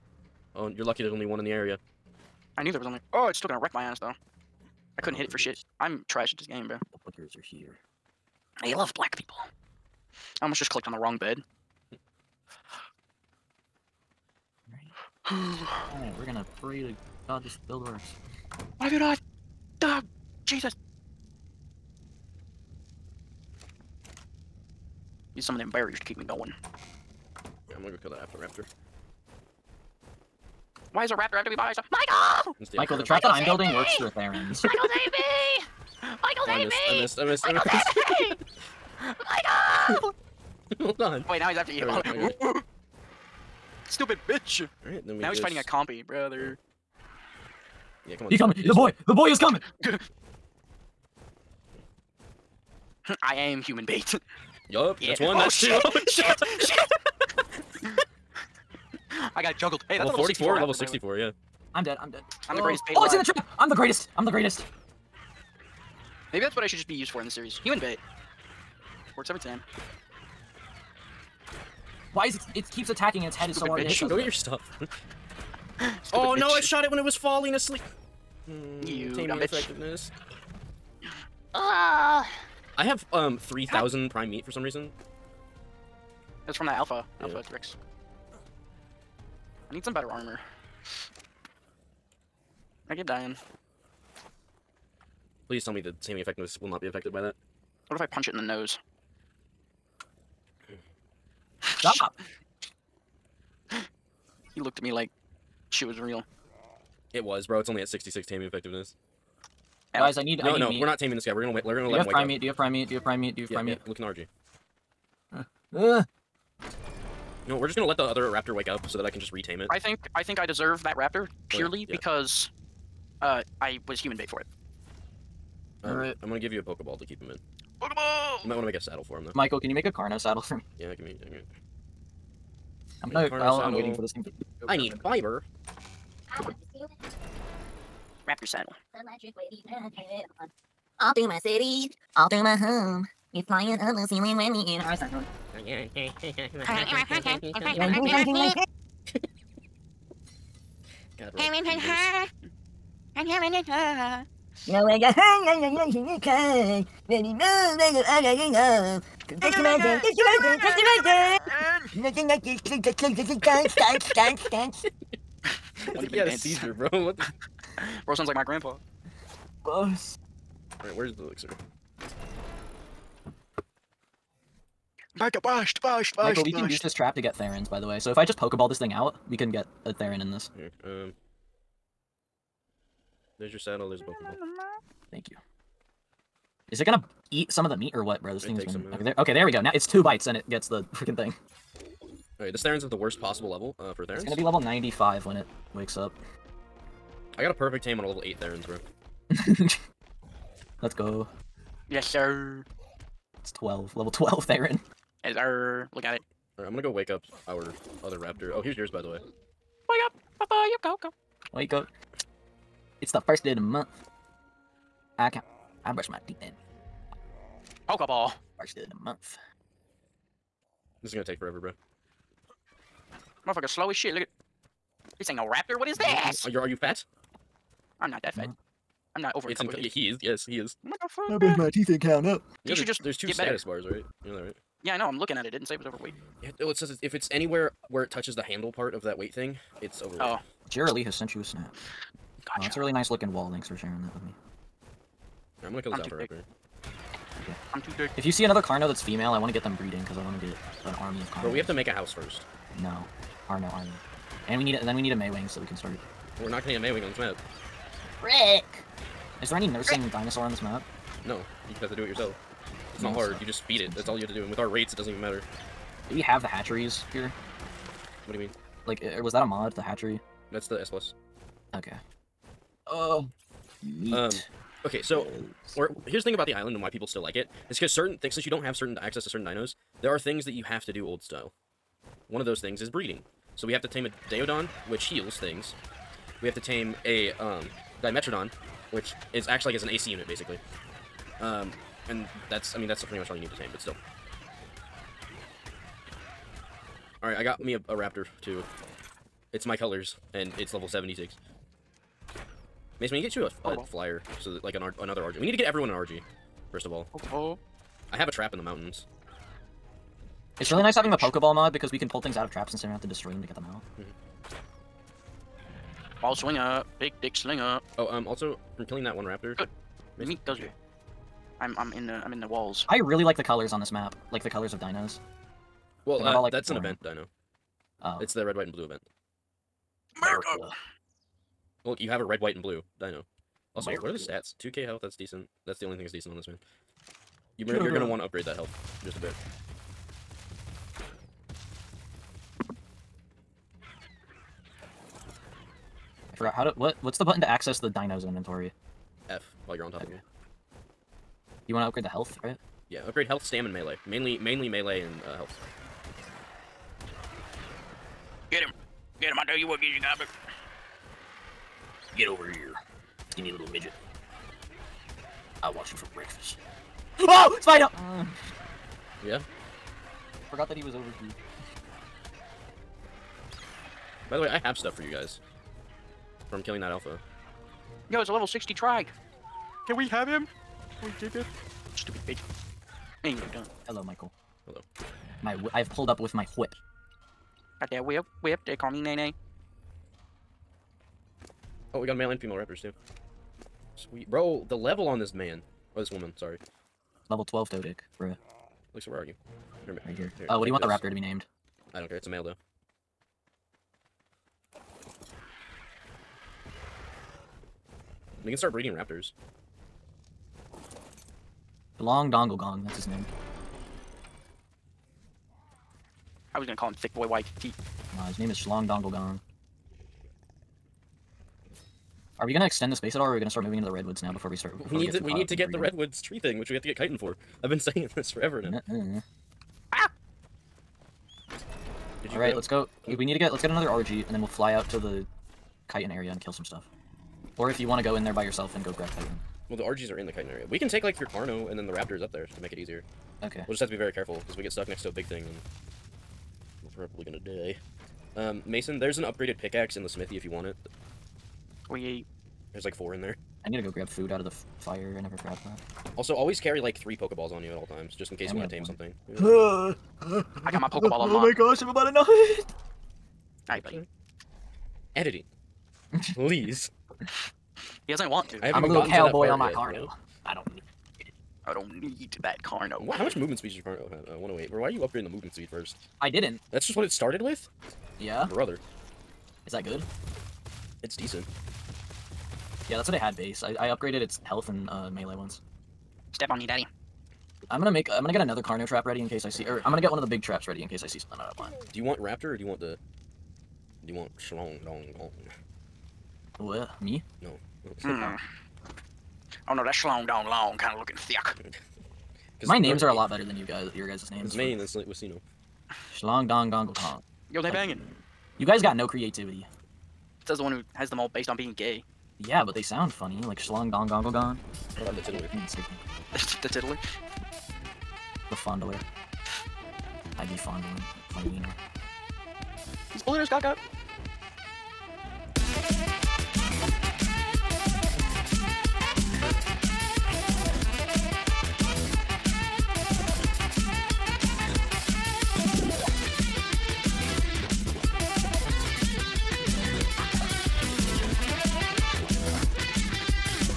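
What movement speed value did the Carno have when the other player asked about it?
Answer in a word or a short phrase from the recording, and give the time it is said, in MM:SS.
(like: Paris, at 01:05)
108, at 07:54.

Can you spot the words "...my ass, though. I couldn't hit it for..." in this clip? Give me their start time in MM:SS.
00:03.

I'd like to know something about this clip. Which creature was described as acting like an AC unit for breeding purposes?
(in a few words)
Dimetrodon.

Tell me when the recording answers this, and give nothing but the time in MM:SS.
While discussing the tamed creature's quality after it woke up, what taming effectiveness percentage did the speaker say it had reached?
01:47.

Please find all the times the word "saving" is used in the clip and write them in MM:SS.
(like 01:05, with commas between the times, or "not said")
01:35.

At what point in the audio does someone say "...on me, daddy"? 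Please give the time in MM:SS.
08:06.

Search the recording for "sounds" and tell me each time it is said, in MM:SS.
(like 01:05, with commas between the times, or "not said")
02:48, 08:32.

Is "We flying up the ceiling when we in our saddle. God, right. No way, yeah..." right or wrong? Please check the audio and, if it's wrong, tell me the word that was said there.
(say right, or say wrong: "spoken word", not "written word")
right.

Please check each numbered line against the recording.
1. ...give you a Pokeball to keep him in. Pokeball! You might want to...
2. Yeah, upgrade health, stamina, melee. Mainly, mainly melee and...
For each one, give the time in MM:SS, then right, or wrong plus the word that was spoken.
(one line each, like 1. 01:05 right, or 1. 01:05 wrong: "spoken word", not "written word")
1. 02:06 right
2. 05:52 right.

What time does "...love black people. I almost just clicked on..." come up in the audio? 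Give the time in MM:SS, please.
00:08.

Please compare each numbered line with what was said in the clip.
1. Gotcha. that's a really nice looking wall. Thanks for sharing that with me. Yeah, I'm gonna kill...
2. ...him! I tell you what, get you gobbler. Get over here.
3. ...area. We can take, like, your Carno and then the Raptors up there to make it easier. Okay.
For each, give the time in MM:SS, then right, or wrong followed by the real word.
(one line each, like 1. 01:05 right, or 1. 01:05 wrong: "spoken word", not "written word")
1. 04:02 right
2. 05:59 right
3. 07:20 right.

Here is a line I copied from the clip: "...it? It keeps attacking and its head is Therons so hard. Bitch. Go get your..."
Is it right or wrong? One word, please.
wrong.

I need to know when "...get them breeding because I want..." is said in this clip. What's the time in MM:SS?
04:09.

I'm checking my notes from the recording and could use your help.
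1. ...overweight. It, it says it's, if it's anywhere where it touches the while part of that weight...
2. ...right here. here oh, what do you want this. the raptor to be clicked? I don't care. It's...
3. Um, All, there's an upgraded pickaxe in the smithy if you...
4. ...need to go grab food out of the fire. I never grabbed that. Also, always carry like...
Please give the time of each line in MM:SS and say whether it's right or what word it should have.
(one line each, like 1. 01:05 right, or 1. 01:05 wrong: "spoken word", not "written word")
1. 03:55 wrong: "handle", not "while"
2. 06:39 wrong: "named", not "clicked"
3. 07:28 wrong: "Mason", not "All"
4. 07:33 right.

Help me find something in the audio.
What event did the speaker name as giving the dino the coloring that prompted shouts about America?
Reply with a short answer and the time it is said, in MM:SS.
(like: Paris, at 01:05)
red, white, and blue event, at 05:28.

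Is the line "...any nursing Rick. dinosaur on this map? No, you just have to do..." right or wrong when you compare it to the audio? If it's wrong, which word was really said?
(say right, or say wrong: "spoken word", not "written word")
right.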